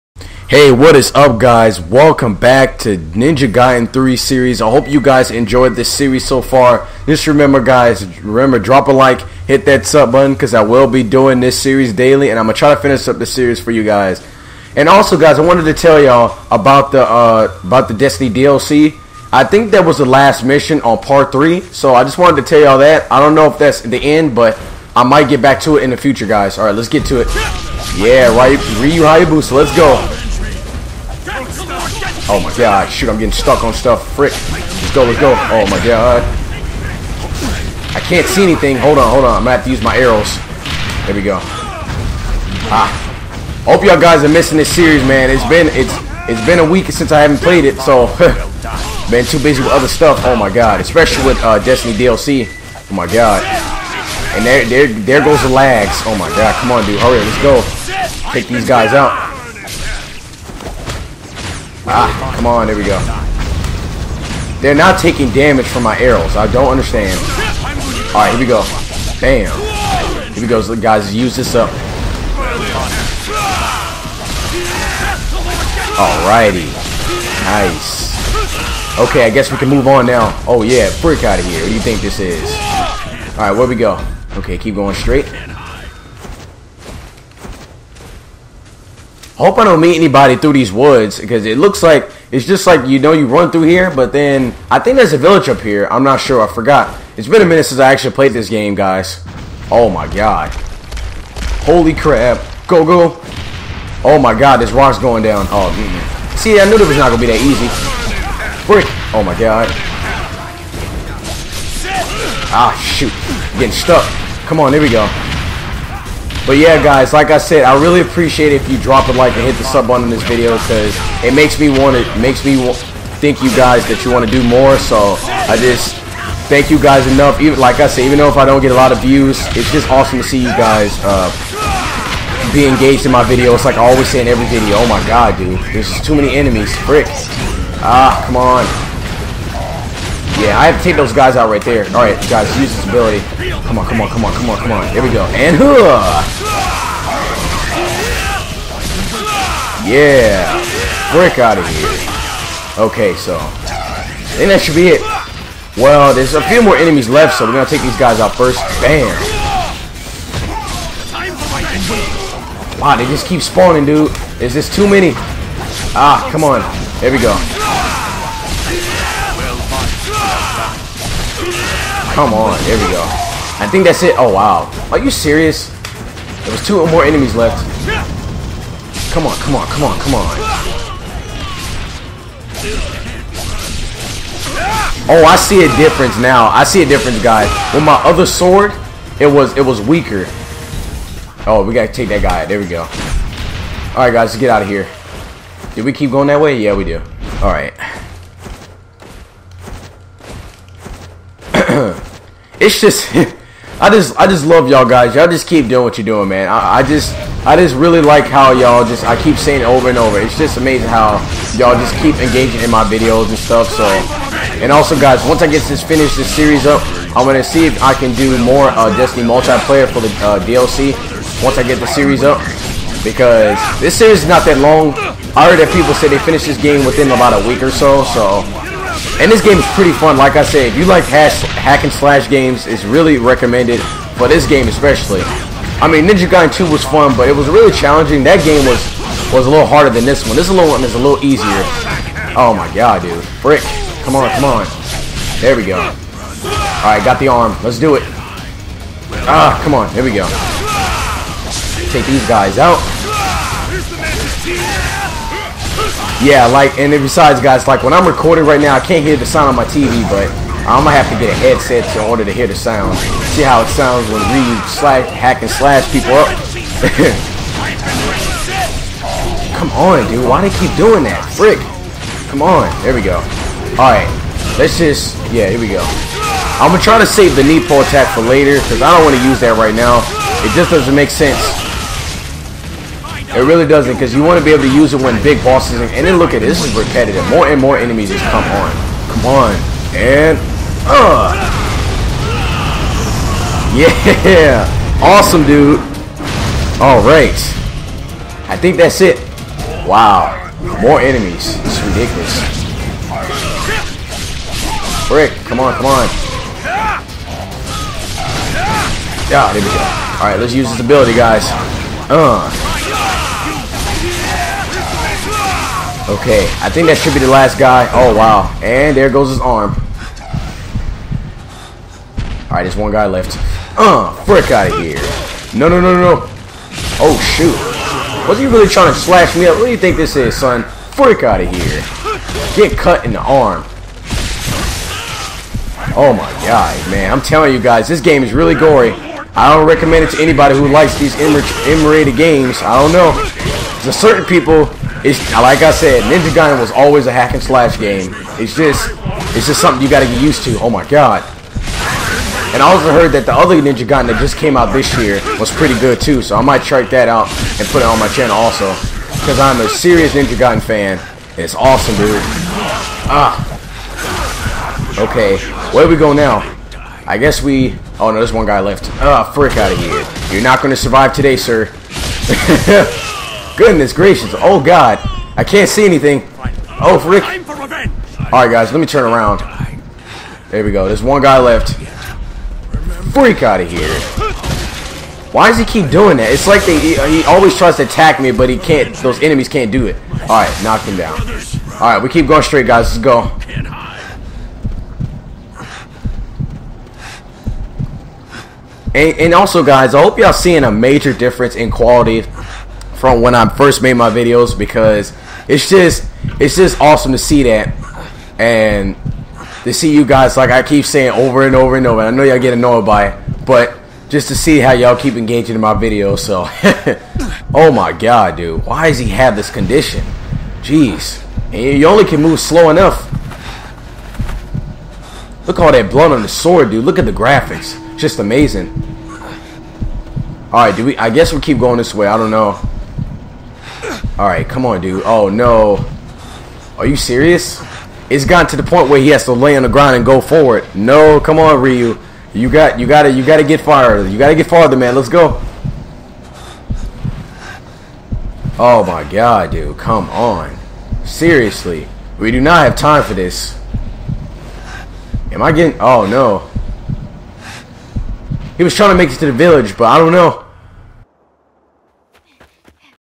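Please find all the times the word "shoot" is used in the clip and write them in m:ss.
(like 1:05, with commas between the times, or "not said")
0:32, 1:52, 5:27.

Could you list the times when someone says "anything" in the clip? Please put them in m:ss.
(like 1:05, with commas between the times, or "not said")
0:38, 6:15.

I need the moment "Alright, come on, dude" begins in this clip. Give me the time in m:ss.
7:14.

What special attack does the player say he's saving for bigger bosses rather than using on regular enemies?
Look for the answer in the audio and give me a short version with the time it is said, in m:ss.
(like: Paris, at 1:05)
Ninpo attack, at 4:37.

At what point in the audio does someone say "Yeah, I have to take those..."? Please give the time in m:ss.
2:20.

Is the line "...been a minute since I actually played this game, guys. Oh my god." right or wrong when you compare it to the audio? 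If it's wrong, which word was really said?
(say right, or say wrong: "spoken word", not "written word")
right.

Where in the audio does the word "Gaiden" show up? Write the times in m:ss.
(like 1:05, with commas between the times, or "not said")
0:03, 3:56, 5:46, 5:53, 6:00.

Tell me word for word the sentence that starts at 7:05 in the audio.
Look all that blood on the sword, dude.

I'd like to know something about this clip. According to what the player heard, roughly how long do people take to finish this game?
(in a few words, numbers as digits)
About a week.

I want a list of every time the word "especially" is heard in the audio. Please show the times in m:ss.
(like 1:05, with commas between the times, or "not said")
0:50, 3:54.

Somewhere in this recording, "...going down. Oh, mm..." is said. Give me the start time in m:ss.
1:44.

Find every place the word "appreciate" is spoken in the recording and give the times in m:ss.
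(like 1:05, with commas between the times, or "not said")
1:58.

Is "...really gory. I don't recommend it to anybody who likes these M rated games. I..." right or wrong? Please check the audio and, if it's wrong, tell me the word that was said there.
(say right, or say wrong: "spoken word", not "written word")
right.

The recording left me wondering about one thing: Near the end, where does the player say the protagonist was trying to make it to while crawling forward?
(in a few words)
The village.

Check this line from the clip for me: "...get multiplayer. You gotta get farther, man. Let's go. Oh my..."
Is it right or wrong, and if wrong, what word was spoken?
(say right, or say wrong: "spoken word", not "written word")
wrong: "farther", not "multiplayer".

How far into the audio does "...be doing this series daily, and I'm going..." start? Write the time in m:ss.
0:10.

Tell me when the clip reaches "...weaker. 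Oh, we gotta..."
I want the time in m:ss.
3:09.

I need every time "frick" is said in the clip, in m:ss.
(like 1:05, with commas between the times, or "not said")
0:34, 2:16, 4:31, 5:24, 5:30, 6:09, 6:16.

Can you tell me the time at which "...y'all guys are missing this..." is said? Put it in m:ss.
0:43.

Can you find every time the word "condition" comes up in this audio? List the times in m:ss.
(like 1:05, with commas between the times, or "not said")
6:59.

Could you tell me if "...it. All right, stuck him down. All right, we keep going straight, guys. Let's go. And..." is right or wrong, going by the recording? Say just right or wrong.
wrong.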